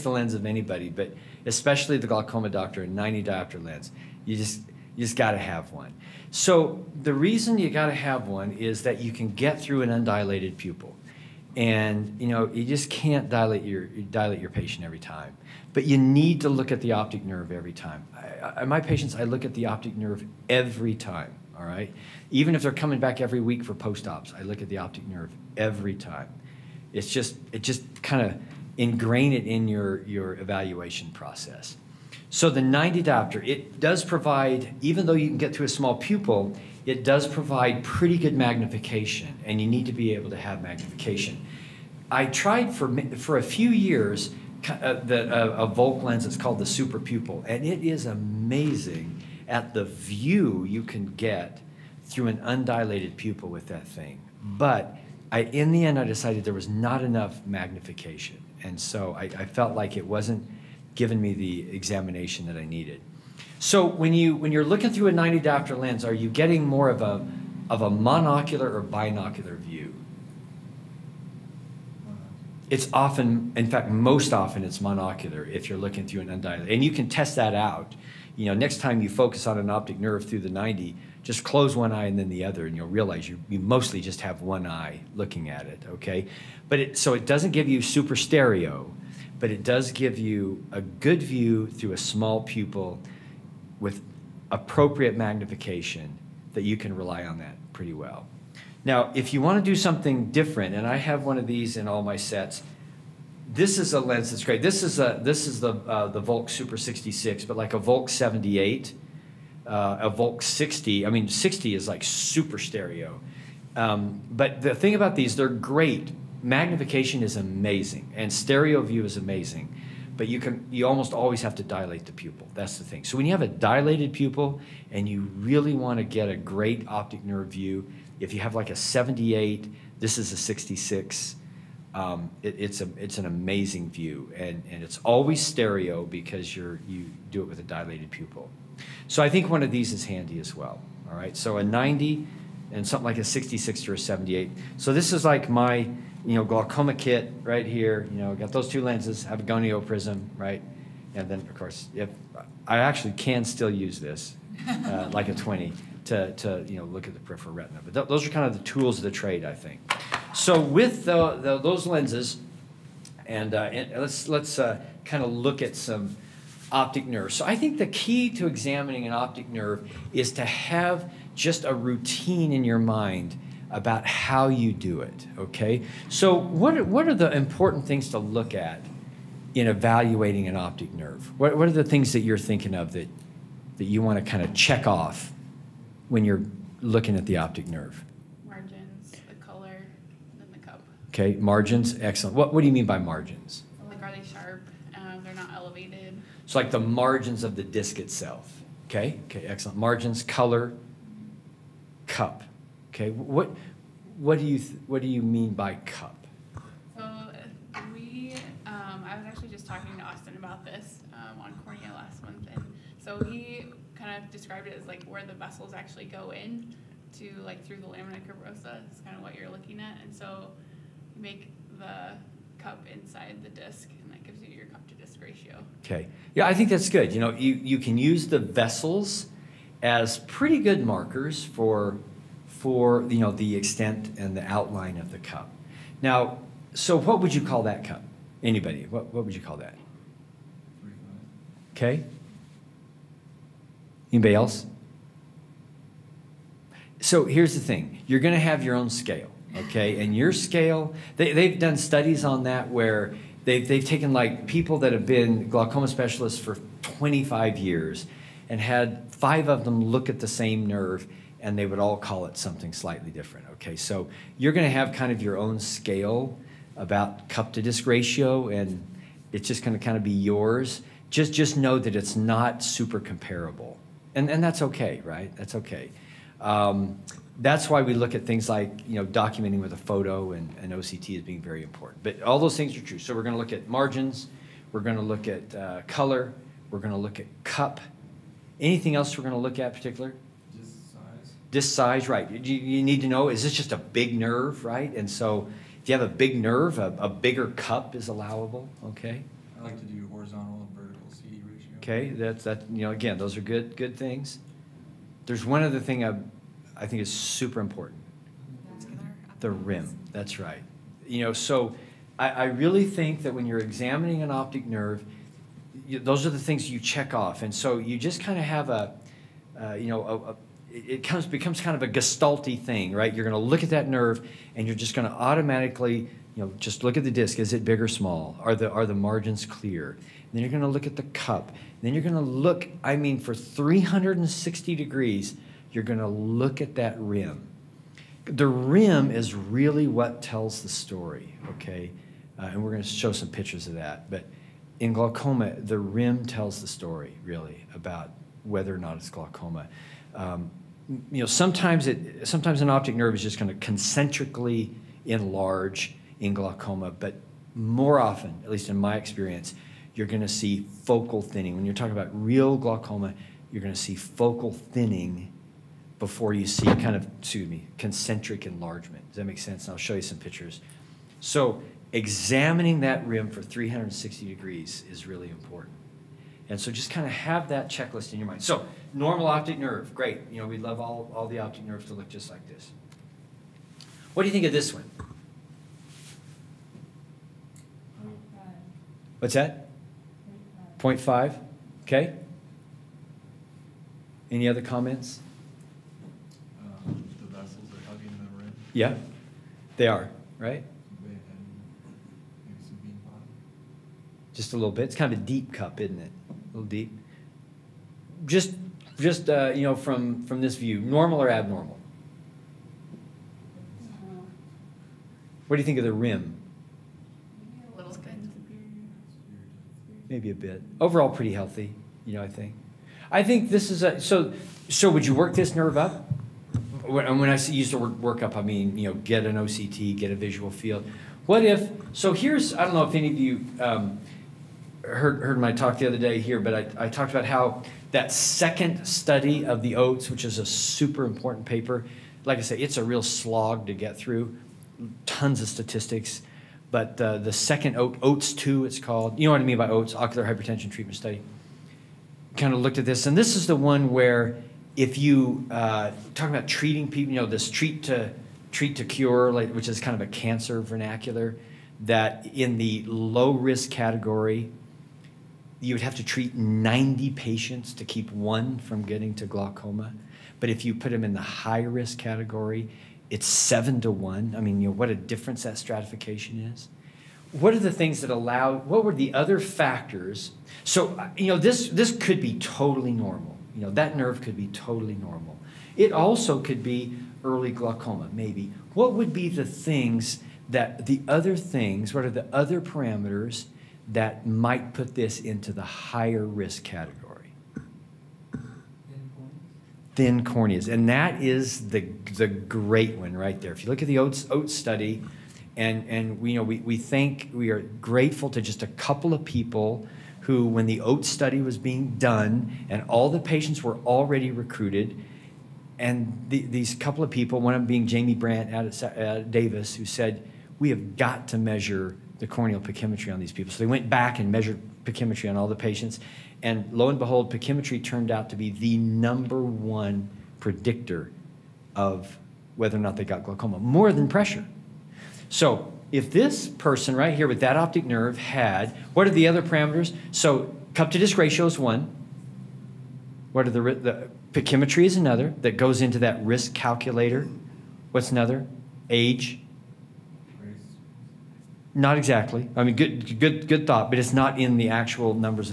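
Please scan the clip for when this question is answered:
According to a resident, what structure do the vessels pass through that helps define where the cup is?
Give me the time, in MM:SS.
03:37.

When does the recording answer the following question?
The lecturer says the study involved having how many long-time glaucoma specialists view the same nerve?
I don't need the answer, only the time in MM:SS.
04:19.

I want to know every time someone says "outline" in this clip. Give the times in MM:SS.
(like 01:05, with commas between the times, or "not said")
03:54.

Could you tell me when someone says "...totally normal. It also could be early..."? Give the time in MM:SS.
08:04.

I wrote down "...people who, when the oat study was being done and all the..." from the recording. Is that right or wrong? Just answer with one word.
right.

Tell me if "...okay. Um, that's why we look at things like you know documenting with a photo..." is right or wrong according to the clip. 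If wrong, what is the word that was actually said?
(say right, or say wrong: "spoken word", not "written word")
right.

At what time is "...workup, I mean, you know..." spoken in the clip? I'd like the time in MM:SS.
07:08.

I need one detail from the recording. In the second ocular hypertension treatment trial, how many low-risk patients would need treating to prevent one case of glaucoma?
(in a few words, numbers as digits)
90.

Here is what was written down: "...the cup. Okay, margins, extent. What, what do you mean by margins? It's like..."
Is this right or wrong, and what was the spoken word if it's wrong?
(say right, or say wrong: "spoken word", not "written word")
wrong: "excellent", not "extent".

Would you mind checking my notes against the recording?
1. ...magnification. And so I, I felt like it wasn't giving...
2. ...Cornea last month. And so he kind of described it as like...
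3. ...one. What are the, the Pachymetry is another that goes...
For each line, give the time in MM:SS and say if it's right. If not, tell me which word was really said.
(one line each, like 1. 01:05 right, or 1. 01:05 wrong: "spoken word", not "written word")
1. 00:57 right
2. 03:31 right
3. 09:01 right.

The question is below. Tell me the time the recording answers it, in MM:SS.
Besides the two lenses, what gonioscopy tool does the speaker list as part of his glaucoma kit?
02:29.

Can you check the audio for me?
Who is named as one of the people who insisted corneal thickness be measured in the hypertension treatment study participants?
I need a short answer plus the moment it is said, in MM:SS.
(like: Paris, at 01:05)
Jamie Brandt, at 08:37.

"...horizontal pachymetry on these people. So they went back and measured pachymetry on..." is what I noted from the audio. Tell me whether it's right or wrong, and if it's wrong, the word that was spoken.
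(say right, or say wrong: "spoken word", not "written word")
wrong: "corneal", not "horizontal".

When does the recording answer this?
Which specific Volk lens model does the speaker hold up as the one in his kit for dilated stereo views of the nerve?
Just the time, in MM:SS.
01:46.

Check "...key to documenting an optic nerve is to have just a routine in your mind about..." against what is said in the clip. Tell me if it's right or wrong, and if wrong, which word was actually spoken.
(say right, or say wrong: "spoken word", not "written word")
wrong: "examining", not "documenting".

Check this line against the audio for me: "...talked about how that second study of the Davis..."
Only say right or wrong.
wrong.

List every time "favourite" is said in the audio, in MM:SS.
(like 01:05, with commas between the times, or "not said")
not said.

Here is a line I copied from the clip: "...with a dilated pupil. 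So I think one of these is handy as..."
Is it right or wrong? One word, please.
right.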